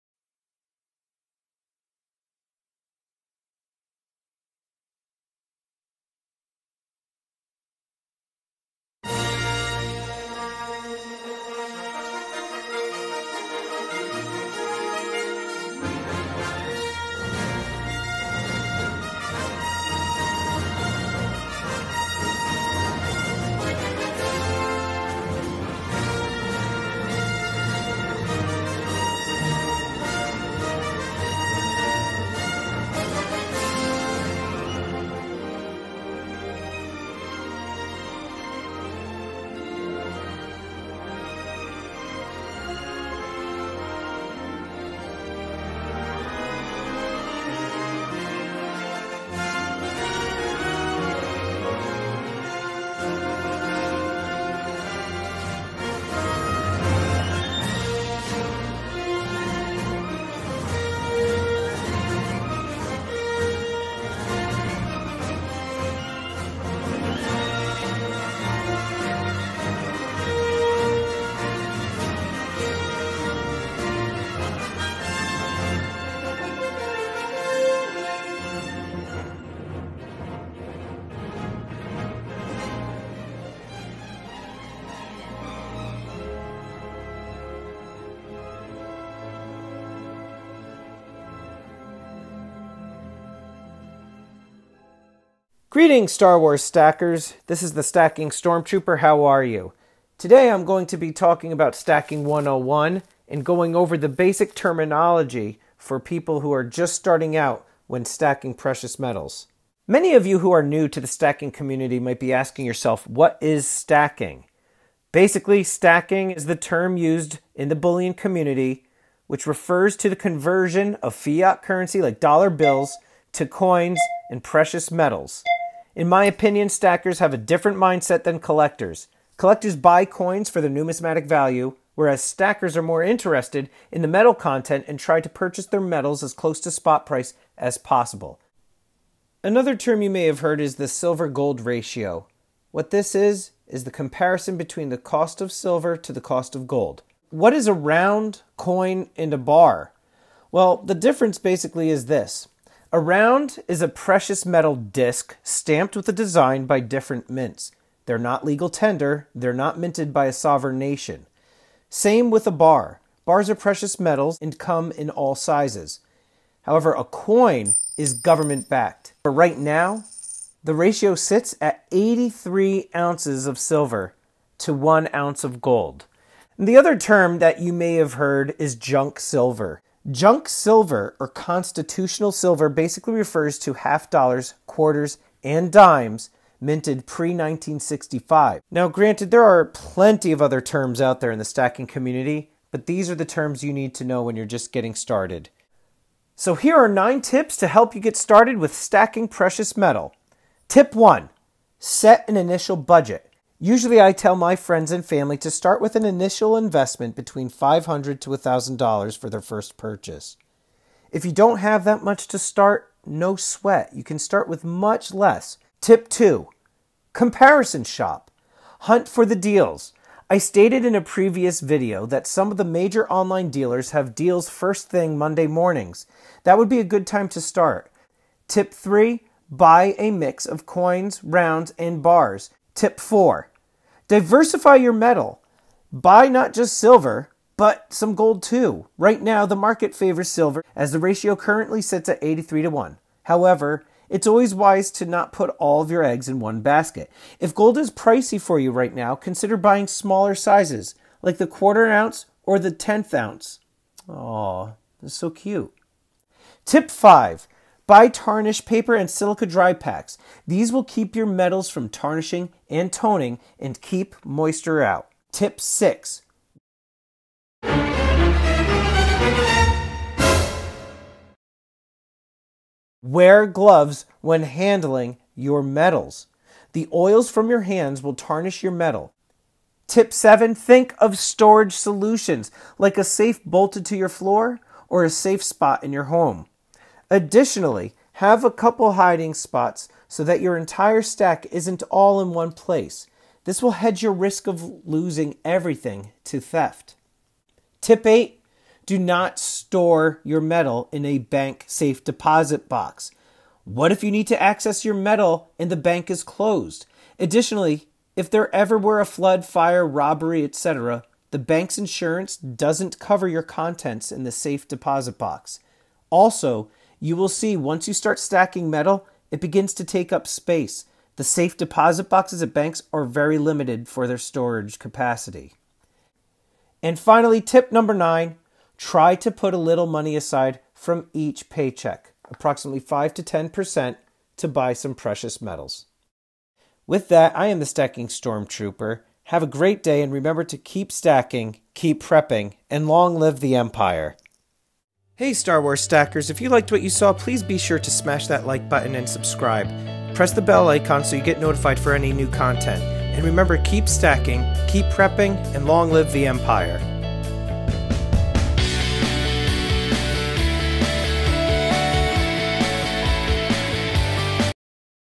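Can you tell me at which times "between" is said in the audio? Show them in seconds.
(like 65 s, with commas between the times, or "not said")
144 s, 207 s.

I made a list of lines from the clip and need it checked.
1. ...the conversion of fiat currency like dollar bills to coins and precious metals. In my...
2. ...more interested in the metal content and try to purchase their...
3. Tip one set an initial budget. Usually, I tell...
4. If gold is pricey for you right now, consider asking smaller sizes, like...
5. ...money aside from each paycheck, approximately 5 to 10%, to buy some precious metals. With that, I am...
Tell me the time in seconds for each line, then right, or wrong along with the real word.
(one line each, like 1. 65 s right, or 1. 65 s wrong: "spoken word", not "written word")
1. 120 s right
2. 132 s right
3. 200 s right
4. 247 s wrong: "buying", not "asking"
5. 329 s right.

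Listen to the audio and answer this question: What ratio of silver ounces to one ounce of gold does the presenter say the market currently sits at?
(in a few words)
83.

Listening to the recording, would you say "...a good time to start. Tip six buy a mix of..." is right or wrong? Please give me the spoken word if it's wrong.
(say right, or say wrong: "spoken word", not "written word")
wrong: "three", not "six".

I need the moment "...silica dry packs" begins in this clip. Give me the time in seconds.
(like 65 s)
259 s.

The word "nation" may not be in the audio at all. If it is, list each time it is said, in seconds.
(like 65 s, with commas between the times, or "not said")
160 s.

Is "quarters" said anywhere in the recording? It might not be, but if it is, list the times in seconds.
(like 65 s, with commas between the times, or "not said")
184 s, 251 s.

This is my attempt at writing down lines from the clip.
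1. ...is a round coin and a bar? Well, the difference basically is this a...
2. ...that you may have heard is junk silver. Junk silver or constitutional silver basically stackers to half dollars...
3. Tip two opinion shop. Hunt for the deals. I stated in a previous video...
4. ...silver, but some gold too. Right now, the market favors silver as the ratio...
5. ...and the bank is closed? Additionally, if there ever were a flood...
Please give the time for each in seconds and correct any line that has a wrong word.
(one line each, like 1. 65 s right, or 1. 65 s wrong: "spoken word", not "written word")
1. 147 s right
2. 177 s wrong: "refers", not "stackers"
3. 215 s wrong: "comparison", not "opinion"
4. 236 s right
5. 305 s right.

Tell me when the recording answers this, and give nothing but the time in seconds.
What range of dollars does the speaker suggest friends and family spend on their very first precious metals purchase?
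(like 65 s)
207 s.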